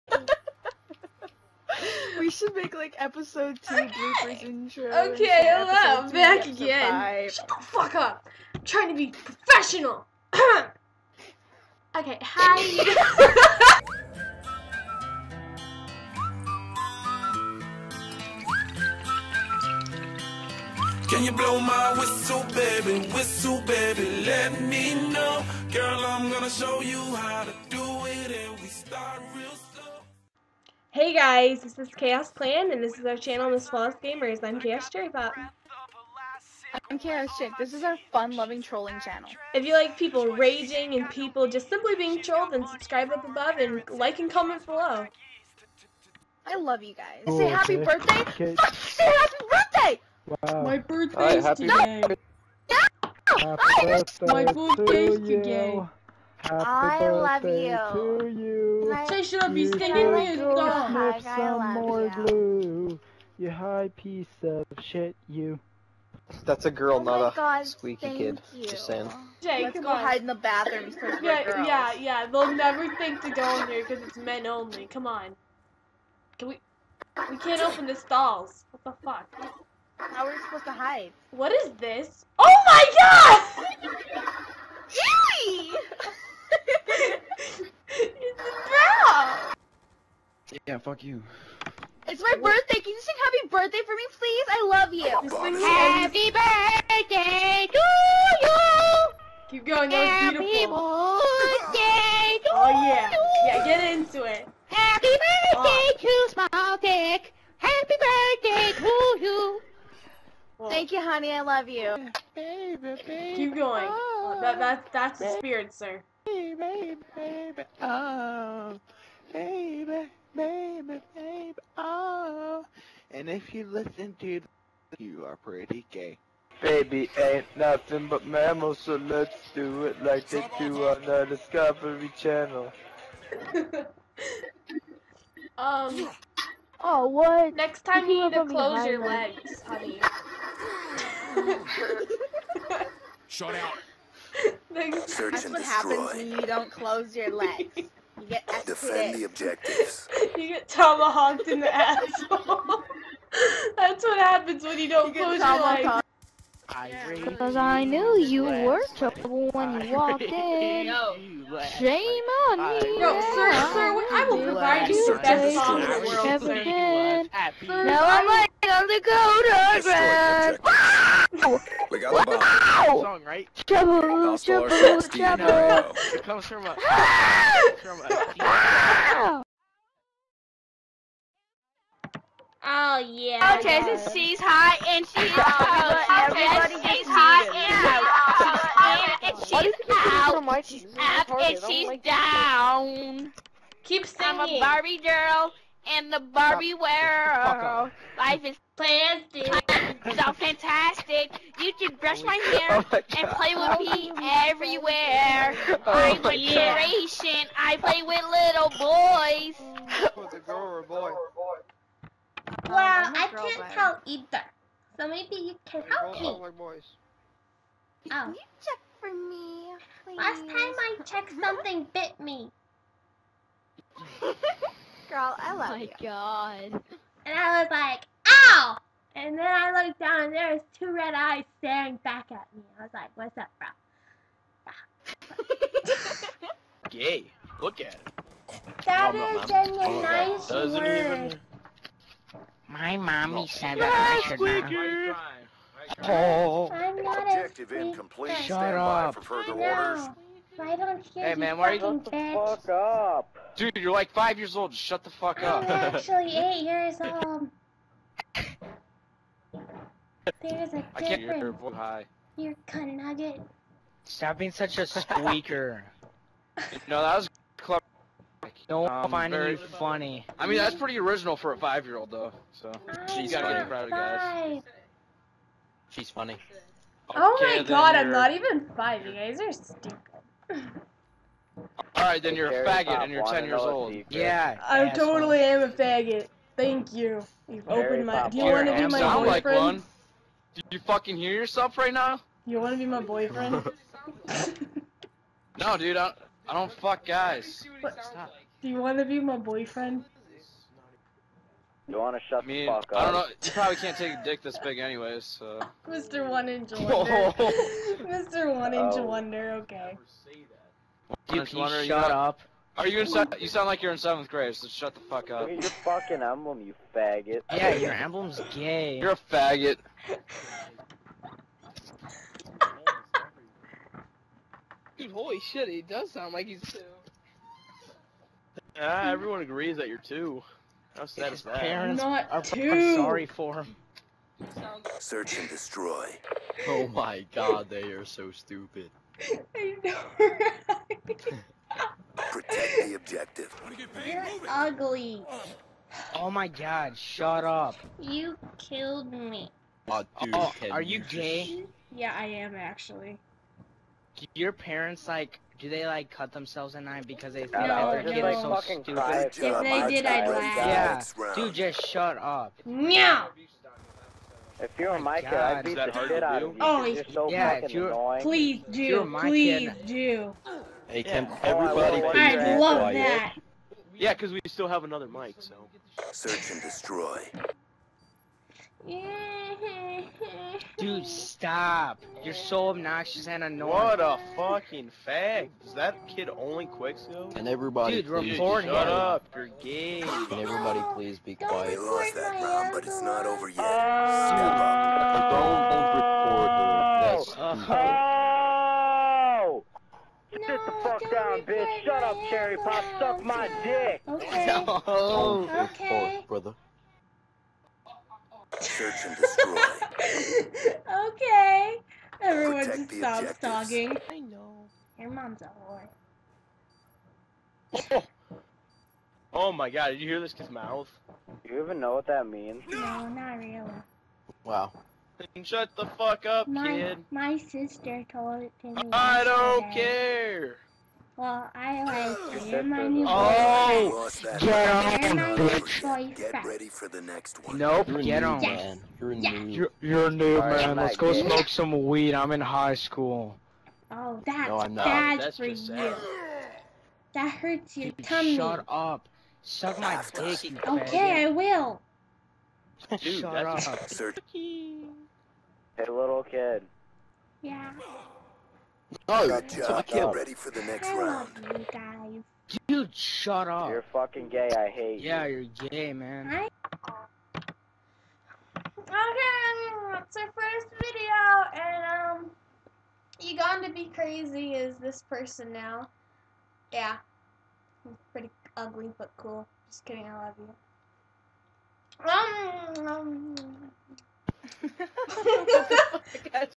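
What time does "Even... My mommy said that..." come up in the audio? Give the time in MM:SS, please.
04:01.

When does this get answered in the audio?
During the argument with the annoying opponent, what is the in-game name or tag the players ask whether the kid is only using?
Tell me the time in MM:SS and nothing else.
06:26.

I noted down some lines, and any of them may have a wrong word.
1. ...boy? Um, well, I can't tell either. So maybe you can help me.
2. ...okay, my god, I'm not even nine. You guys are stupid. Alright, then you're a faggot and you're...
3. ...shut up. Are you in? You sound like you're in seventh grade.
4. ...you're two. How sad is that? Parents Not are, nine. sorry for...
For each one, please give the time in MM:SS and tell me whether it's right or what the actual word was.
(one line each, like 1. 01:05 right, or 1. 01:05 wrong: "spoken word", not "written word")
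1. 03:30 right
2. 04:37 wrong: "five", not "nine"
3. 05:11 right
4. 05:29 wrong: "two", not "nine".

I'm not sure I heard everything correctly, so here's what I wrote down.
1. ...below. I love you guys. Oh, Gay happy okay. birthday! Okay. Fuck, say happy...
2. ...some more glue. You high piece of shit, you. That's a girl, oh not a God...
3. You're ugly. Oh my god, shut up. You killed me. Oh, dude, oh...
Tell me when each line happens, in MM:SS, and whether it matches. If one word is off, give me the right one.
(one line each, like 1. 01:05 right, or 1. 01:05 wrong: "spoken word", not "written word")
1. 00:44 wrong: "Say", not "Gay"
2. 01:01 right
3. 05:44 right.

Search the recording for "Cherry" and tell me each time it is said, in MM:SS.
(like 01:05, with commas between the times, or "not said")
00:34, 06:42.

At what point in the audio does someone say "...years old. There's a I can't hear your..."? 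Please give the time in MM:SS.
04:16.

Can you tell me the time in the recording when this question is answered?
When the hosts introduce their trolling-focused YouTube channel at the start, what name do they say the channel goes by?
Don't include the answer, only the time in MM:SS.
00:33.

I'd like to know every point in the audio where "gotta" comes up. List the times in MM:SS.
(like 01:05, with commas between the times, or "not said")
04:33.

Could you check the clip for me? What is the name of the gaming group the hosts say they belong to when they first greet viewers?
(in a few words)
Khaos Clan.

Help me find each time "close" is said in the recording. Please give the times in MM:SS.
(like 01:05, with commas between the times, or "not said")
02:18, 02:26, 02:35.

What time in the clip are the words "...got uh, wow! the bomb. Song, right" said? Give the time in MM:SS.
02:52.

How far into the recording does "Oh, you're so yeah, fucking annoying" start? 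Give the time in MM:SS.
06:06.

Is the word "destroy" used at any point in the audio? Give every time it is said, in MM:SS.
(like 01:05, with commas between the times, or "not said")
02:25, 05:35, 06:16, 06:49.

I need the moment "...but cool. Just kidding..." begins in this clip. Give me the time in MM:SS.
07:58.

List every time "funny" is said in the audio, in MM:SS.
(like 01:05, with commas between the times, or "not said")
04:29, 04:36.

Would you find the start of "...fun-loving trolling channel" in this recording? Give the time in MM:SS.
00:38.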